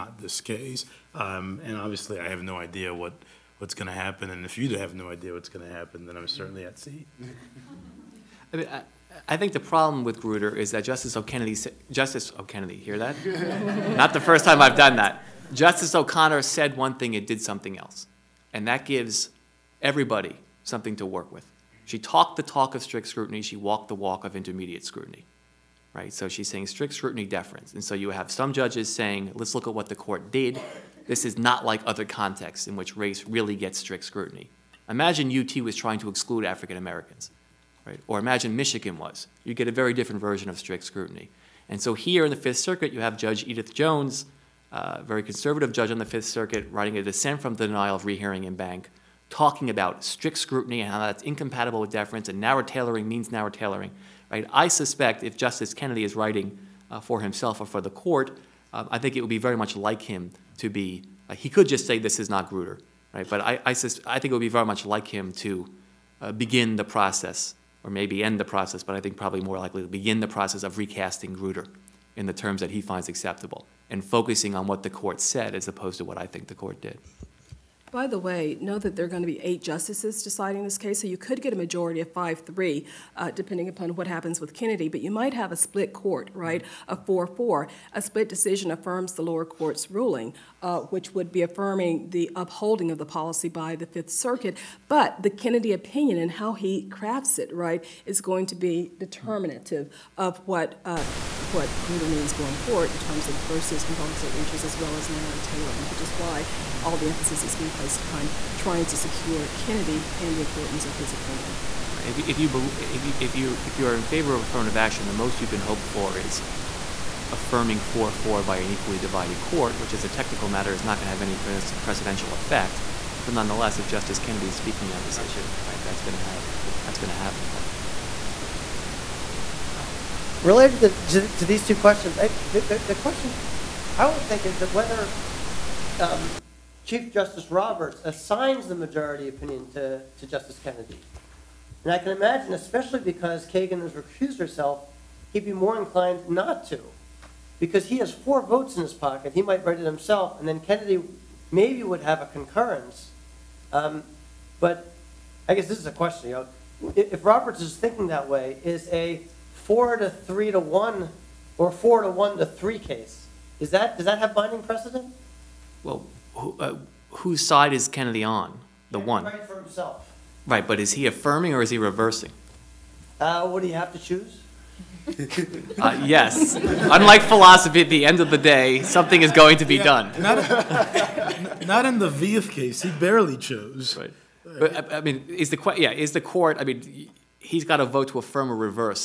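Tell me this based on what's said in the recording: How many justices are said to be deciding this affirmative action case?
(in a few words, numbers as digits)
8.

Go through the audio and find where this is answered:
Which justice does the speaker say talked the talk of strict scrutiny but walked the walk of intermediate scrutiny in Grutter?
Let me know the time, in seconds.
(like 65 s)
15 s.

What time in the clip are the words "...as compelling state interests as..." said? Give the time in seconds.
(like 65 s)
103 s.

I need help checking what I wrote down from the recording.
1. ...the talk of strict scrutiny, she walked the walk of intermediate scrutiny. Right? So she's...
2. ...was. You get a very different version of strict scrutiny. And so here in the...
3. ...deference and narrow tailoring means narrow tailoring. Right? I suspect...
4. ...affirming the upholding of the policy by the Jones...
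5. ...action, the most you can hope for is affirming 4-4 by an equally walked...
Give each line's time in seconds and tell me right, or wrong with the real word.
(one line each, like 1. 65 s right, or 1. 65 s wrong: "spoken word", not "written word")
1. 22 s right
2. 38 s right
3. 51 s right
4. 91 s wrong: "Fifth", not "Jones"
5. 114 s wrong: "divided", not "walked".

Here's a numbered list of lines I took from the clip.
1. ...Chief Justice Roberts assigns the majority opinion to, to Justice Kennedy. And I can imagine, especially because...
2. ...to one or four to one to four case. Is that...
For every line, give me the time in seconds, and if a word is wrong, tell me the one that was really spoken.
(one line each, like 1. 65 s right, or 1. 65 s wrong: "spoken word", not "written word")
1. 136 s right
2. 160 s wrong: "three", not "four".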